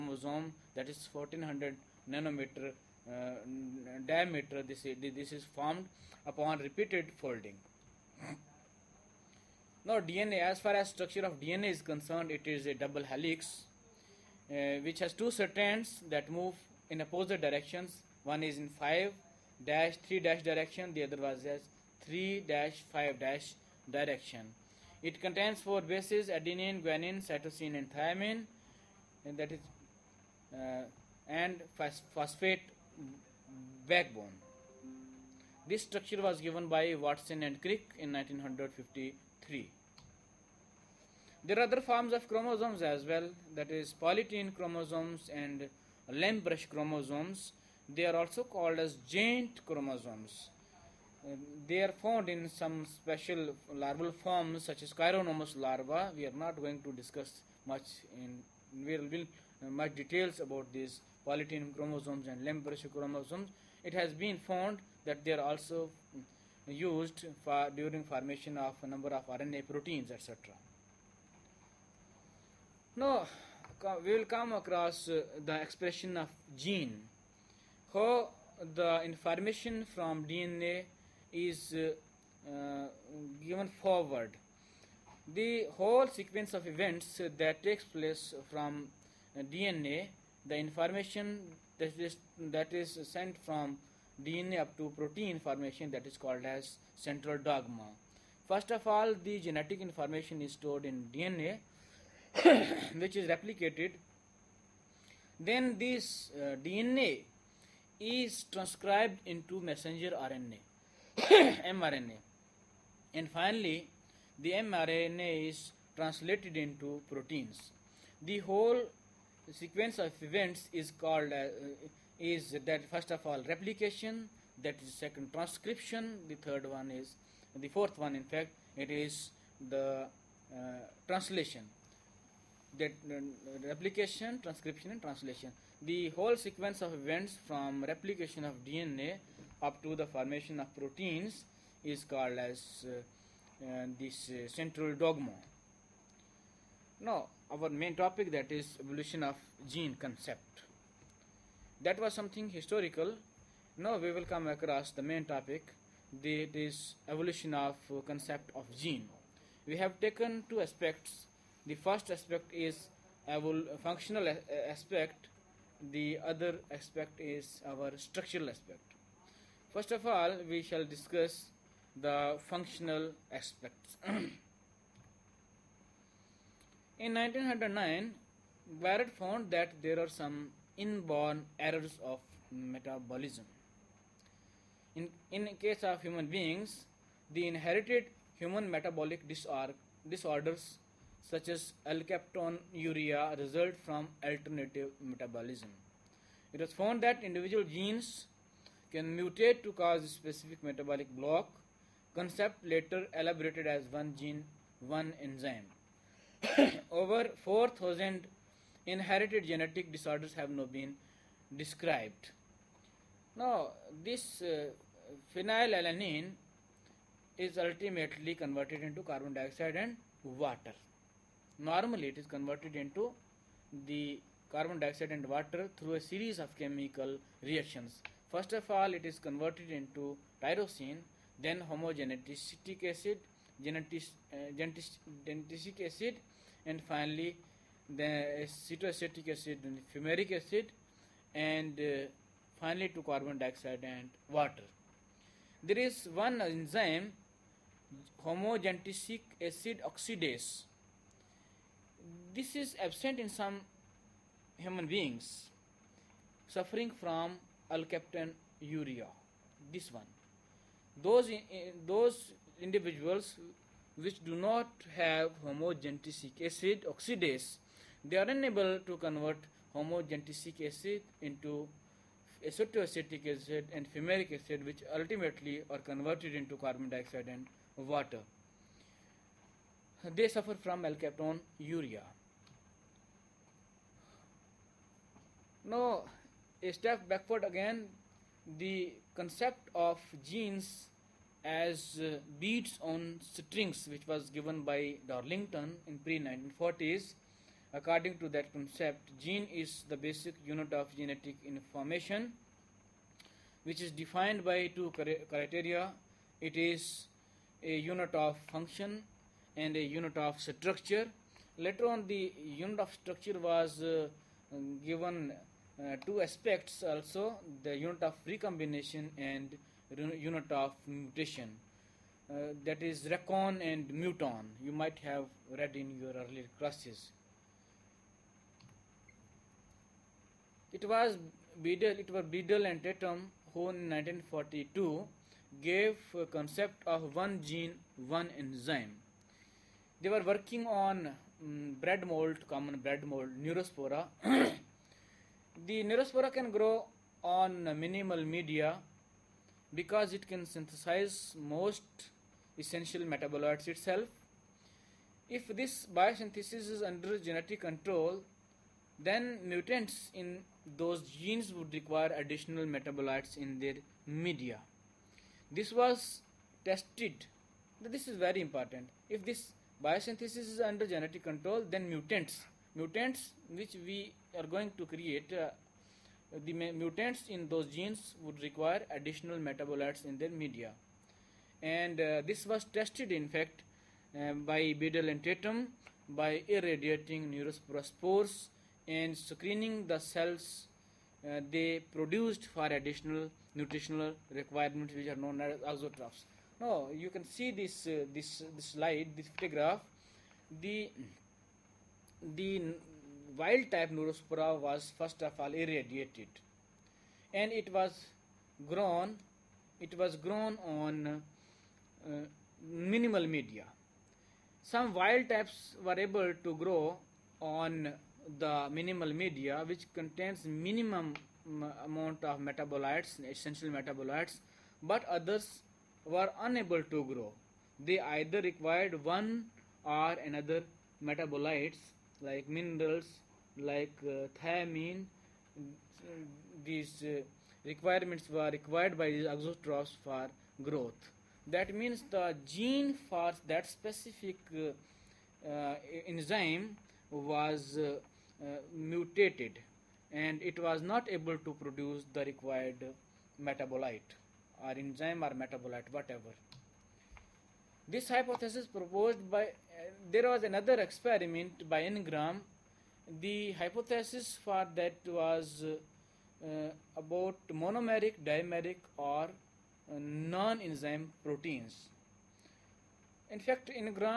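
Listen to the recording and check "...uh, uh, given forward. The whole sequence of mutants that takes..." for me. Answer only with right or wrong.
wrong.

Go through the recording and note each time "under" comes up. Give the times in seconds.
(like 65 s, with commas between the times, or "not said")
356 s, 370 s.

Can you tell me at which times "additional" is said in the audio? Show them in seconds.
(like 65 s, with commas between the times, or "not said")
362 s, 378 s, 392 s.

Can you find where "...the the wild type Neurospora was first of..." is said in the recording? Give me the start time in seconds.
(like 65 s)
400 s.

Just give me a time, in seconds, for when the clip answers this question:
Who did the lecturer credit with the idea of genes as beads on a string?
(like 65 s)
295 s.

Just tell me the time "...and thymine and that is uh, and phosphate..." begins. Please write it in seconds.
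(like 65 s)
27 s.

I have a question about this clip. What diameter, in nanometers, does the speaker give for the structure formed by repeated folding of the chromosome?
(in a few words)
1400.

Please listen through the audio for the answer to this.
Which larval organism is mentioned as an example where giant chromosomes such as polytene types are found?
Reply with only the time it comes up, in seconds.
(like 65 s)
54 s.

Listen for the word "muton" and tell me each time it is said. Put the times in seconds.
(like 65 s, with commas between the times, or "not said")
323 s.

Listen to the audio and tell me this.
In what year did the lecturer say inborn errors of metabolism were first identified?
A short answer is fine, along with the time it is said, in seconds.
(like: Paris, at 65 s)
1909, at 177 s.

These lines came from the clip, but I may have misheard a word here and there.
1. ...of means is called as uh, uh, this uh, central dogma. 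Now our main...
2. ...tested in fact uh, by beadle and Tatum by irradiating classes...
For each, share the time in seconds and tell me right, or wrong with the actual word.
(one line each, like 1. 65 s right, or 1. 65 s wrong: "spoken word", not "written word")
1. 140 s wrong: "proteins", not "means"
2. 382 s wrong: "neurospores", not "classes".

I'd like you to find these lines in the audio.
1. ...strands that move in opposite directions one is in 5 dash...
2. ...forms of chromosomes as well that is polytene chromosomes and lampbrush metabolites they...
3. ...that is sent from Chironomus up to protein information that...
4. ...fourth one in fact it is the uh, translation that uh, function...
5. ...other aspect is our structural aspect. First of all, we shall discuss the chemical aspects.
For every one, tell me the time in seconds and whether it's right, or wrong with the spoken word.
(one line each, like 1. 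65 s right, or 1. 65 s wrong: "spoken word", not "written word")
1. 15 s right
2. 41 s wrong: "chromosomes", not "metabolites"
3. 92 s wrong: "DNA", not "Chironomus"
4. 127 s wrong: "replication", not "function"
5. 166 s wrong: "functional", not "chemical".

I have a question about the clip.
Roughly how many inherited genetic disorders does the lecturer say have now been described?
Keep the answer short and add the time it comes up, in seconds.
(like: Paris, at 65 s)
4,000, at 206 s.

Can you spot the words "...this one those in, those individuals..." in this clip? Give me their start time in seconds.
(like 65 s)
259 s.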